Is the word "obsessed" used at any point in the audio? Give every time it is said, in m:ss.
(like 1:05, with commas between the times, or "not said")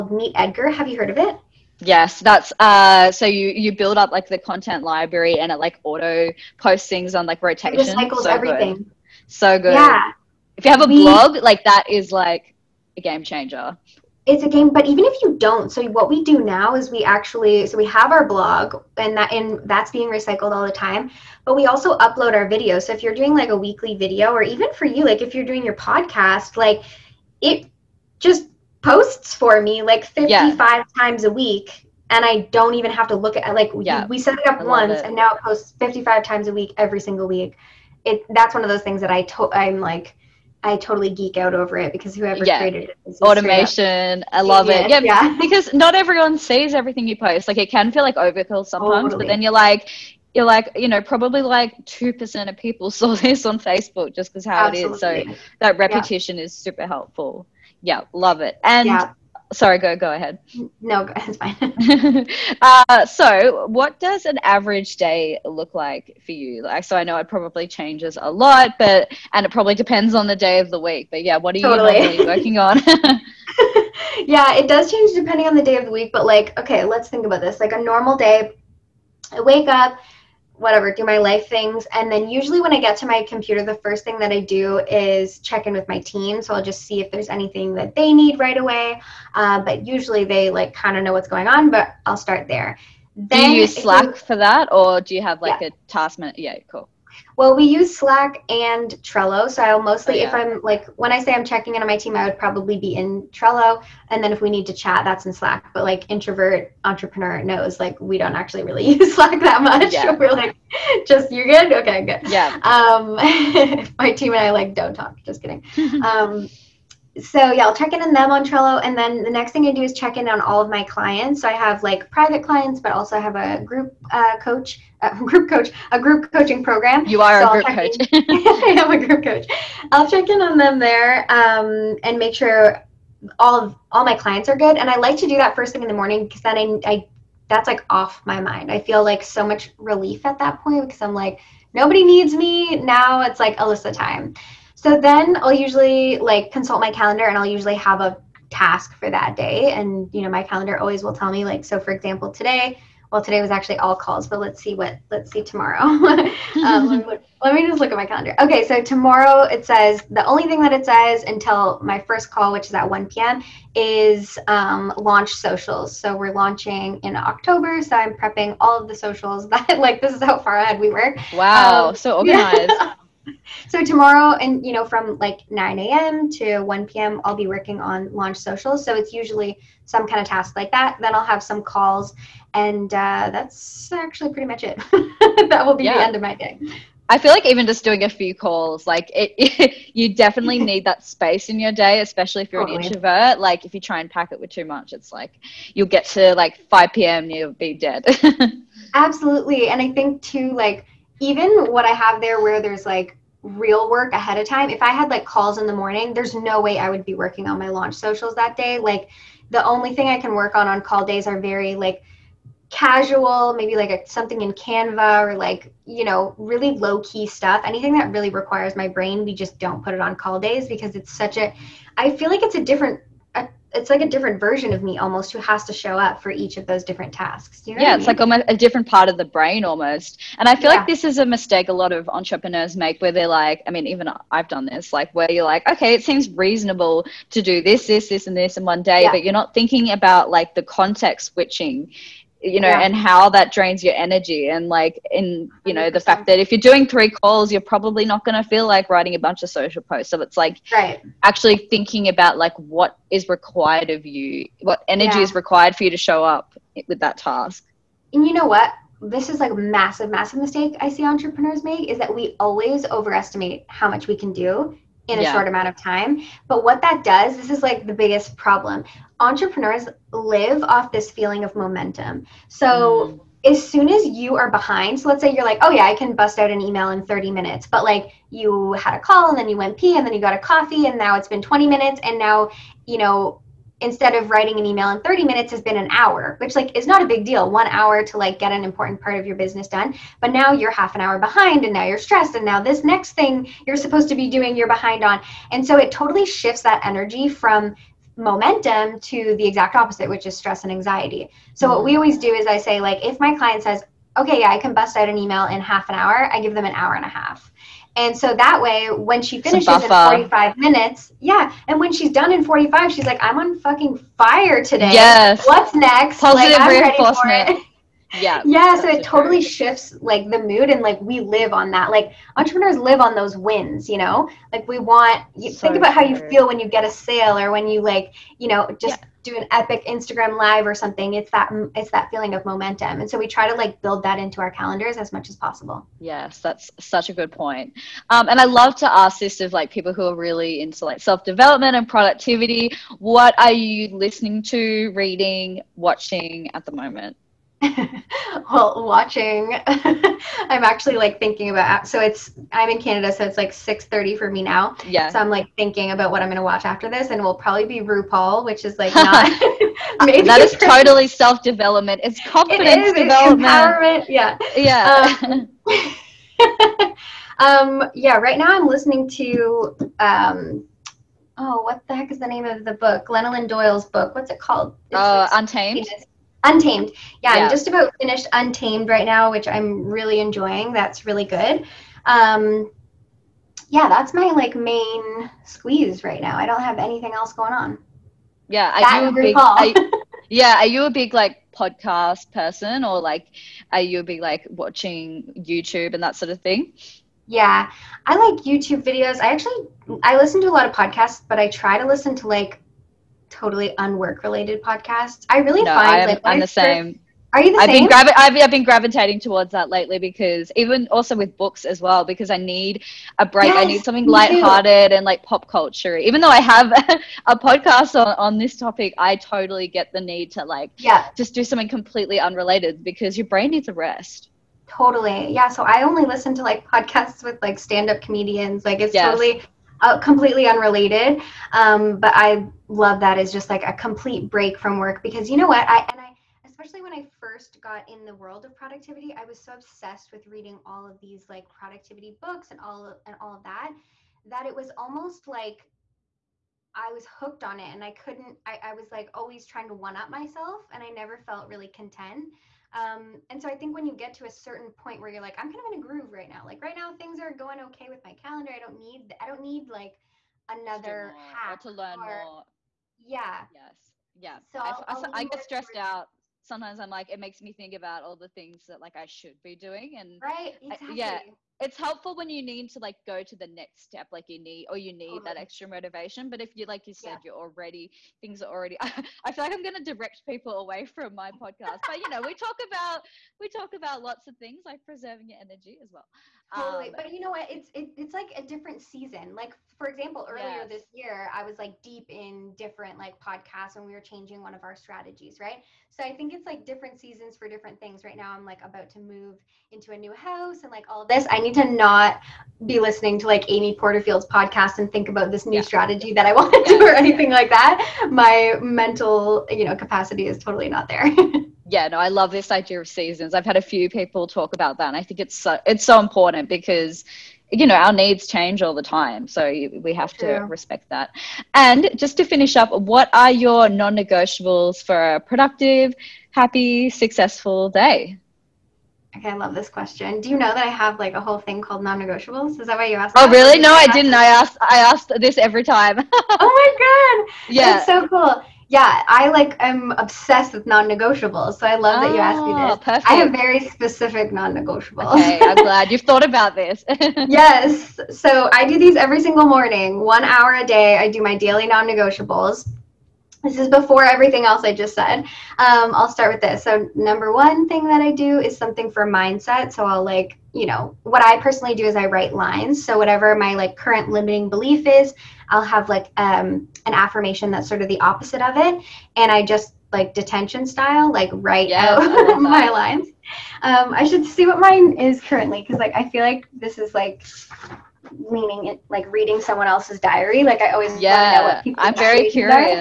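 7:19, 8:59.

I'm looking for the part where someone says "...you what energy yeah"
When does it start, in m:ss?
4:14.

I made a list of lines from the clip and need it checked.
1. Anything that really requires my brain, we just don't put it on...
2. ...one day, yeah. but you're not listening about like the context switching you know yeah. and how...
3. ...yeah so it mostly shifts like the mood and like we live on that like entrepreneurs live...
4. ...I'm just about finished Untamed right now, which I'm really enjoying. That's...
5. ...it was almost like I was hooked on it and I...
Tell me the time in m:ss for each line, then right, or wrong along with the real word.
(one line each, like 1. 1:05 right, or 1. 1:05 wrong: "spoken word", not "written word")
1. 3:37 right
2. 3:58 wrong: "thinking", not "listening"
3. 5:18 wrong: "totally", not "mostly"
4. 6:17 right
5. 7:24 right.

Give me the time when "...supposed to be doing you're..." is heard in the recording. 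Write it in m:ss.
4:53.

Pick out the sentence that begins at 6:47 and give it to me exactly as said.
Been gravi- I've, I've, been gravitating towards that lately because even also with books as well because I need a break.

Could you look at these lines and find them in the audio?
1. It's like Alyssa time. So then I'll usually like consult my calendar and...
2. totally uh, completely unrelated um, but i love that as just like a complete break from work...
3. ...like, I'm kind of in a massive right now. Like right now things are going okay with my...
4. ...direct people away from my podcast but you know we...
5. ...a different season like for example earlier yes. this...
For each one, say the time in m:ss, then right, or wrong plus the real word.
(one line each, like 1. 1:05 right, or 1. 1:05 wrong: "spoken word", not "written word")
1. 2:23 right
2. 7:09 right
3. 7:35 wrong: "groove", not "massive"
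4. 7:59 right
5. 8:08 right.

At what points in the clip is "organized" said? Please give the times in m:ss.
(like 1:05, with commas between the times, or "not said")
2:52.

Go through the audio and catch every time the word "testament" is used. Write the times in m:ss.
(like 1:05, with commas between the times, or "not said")
not said.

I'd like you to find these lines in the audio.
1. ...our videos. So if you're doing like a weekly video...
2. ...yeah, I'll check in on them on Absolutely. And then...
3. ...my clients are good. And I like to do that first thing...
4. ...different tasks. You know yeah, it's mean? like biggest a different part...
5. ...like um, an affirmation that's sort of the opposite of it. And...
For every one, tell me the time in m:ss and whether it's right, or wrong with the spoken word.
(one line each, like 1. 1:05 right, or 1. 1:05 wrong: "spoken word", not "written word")
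1. 0:22 right
2. 1:57 wrong: "Trello", not "Absolutely"
3. 2:14 right
4. 3:46 wrong: "almost", not "biggest"
5. 9:25 right.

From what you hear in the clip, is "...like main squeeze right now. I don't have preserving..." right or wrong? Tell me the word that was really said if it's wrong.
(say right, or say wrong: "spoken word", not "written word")
wrong: "anything", not "preserving".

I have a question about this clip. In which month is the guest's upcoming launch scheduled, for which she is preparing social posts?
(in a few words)
October.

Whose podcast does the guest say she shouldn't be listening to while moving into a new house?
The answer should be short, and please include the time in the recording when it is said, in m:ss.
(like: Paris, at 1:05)
Amy Porterfield, at 8:23.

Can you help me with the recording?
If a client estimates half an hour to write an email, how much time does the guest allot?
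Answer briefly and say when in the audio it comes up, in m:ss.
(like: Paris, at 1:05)
an hour and a half, at 5:06.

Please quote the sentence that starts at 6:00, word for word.
maybe that is totally self development.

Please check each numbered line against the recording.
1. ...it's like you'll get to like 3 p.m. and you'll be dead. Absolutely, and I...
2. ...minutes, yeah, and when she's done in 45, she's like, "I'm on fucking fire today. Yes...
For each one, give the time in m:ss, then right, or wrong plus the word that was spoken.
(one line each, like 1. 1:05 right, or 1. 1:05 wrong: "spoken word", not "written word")
1. 3:14 wrong: "5", not "3"
2. 5:10 right.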